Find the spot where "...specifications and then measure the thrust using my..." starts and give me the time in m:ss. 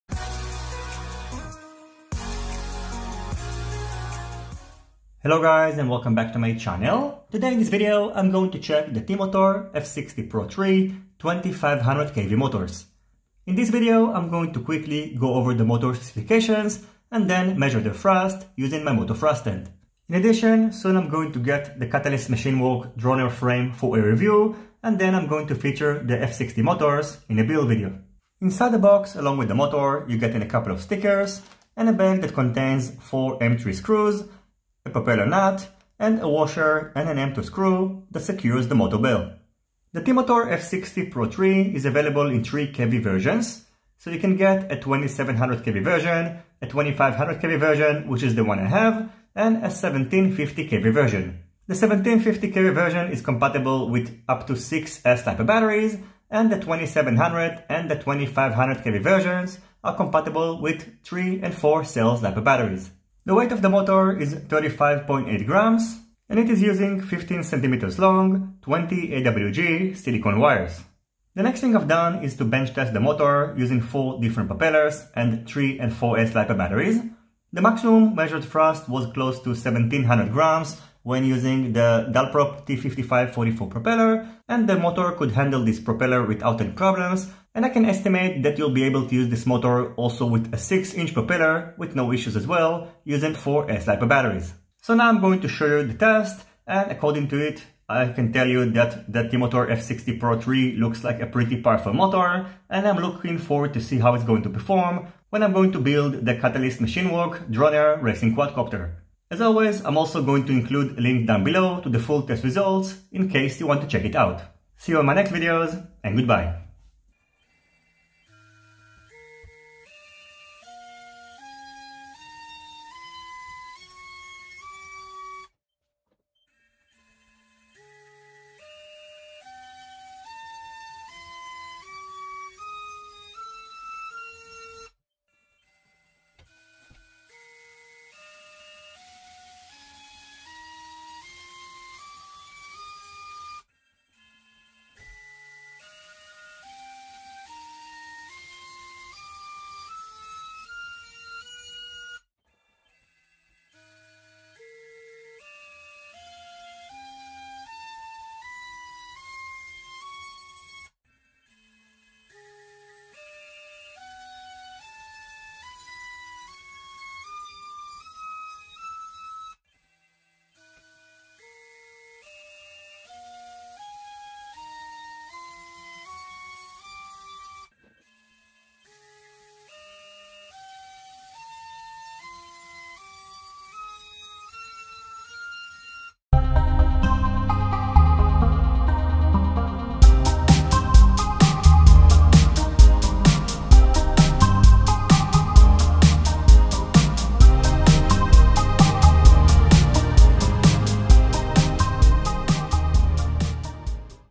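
0:15.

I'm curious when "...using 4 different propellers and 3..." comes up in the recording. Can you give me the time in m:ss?
1:13.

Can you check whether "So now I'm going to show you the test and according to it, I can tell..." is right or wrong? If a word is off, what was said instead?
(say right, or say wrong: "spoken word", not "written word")
right.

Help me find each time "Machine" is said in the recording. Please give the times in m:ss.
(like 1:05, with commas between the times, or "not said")
0:22, 1:46.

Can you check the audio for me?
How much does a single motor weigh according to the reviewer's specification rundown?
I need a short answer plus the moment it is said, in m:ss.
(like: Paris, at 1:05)
35.8 grams, at 1:04.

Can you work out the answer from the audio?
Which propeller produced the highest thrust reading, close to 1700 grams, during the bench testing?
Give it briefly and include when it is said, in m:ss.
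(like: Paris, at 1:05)
Dalprop T5544, at 1:22.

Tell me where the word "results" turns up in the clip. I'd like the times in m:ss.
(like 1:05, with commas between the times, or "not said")
1:52.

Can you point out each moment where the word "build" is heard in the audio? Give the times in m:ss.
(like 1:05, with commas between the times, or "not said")
0:27, 1:45.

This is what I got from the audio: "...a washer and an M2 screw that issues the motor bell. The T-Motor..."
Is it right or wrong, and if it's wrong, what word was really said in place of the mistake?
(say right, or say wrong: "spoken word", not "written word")
wrong: "secures", not "issues".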